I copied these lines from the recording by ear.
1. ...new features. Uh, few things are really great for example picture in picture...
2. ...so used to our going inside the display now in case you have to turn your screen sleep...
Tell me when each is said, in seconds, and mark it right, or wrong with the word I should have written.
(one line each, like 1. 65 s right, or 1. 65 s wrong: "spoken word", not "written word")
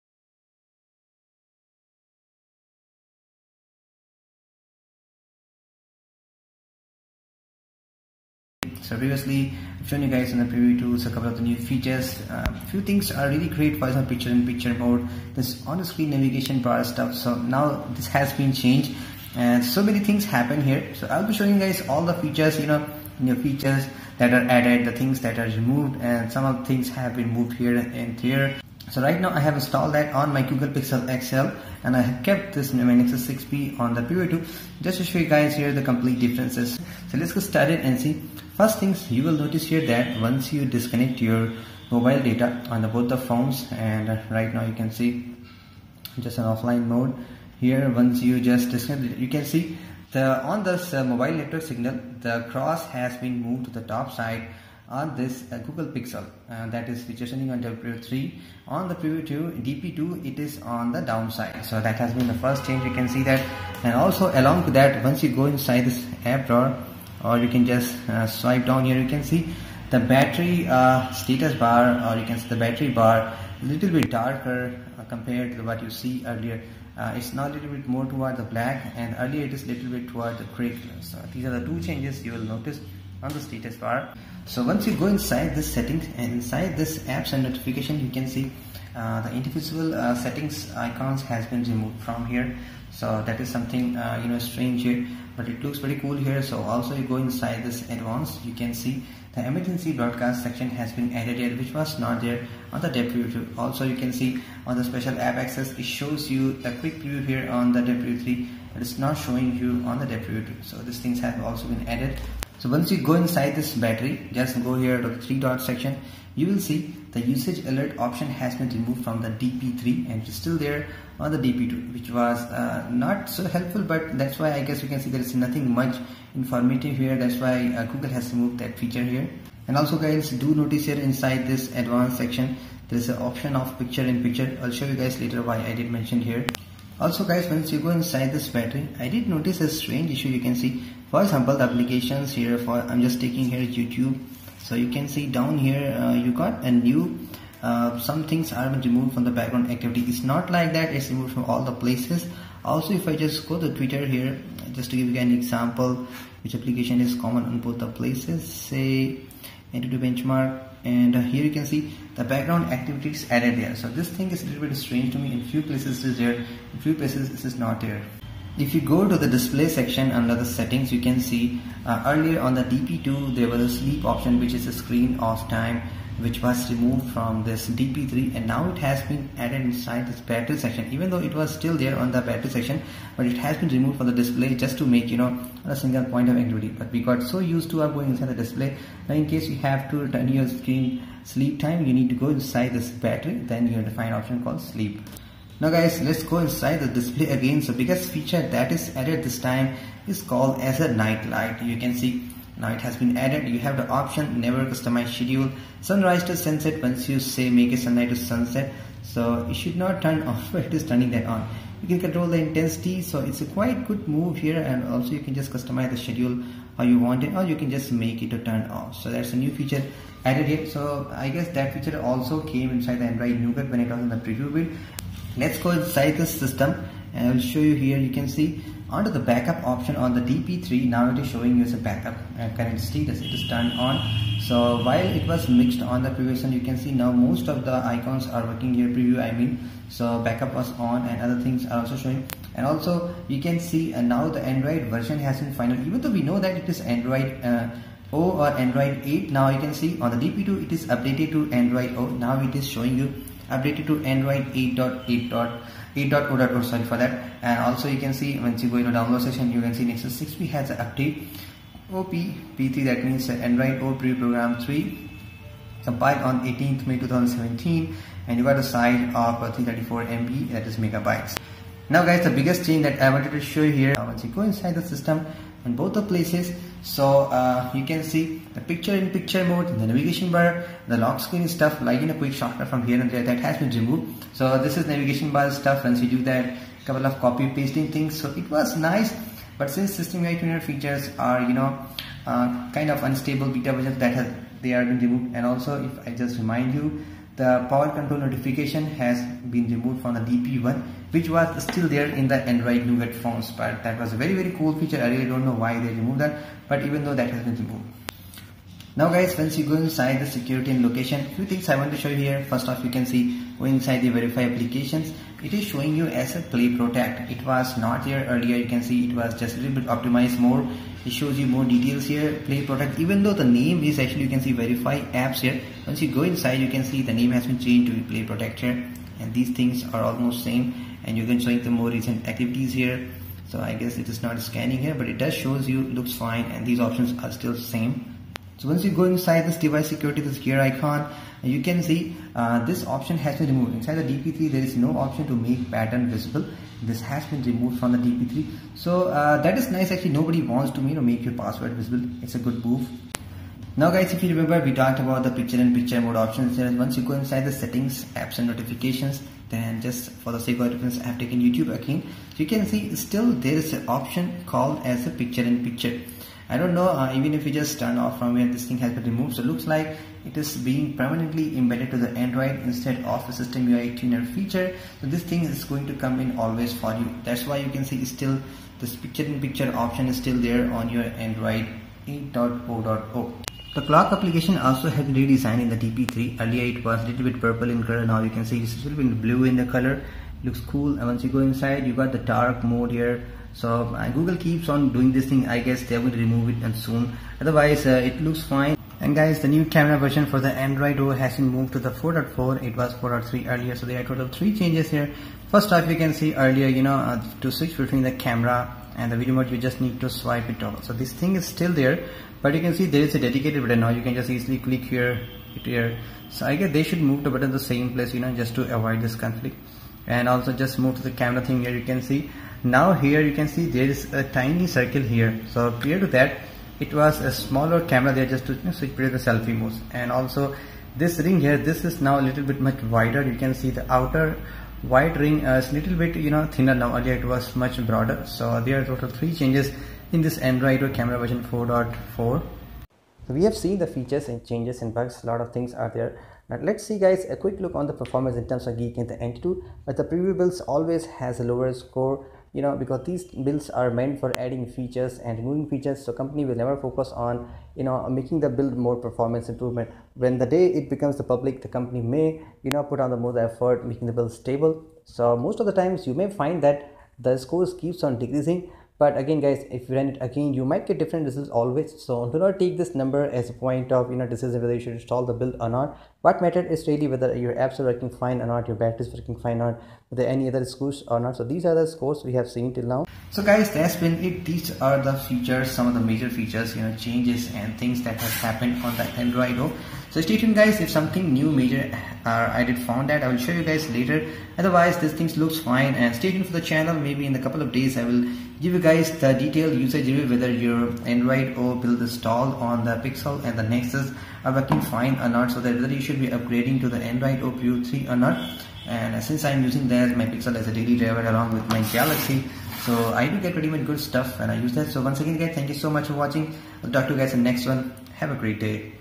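1. 11 s right
2. 187 s right.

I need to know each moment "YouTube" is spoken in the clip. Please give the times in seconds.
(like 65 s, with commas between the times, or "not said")
143 s, 361 s.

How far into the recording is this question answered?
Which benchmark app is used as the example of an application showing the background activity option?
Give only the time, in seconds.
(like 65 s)
159 s.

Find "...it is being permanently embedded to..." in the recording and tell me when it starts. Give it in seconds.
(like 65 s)
370 s.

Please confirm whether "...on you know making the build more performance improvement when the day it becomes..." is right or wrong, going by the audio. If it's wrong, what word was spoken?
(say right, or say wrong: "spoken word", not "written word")
right.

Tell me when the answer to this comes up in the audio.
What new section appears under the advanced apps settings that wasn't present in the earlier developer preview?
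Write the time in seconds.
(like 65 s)
99 s.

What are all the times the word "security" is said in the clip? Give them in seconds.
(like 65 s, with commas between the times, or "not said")
310 s, 339 s.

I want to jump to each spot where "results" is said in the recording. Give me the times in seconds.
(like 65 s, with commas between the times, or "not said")
471 s.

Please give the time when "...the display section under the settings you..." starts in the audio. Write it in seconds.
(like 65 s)
169 s.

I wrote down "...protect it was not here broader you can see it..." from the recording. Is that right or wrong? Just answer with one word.
wrong.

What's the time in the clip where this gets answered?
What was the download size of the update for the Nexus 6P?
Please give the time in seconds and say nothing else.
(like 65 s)
269 s.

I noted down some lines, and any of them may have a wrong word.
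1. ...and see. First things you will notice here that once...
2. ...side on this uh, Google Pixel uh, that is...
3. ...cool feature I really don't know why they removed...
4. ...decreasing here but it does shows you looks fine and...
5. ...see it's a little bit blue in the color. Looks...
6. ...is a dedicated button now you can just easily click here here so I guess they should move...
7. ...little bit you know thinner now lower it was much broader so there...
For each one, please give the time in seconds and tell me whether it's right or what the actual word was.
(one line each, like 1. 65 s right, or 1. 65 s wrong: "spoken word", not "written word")
1. 37 s right
2. 54 s right
3. 304 s right
4. 334 s wrong: "scanning", not "decreasing"
5. 388 s right
6. 413 s right
7. 435 s wrong: "earlier", not "lower".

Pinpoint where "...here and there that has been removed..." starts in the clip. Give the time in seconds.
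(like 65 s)
282 s.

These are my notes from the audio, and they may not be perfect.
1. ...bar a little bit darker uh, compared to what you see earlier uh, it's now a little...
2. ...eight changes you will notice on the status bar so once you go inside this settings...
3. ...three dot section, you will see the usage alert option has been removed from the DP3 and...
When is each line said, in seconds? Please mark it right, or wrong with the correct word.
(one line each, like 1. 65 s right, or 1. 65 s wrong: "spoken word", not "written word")
1. 72 s right
2. 81 s wrong: "two", not "eight"
3. 115 s right.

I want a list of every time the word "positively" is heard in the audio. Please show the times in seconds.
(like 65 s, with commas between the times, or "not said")
not said.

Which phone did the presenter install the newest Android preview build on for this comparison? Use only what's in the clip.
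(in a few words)
Google Pixel XL.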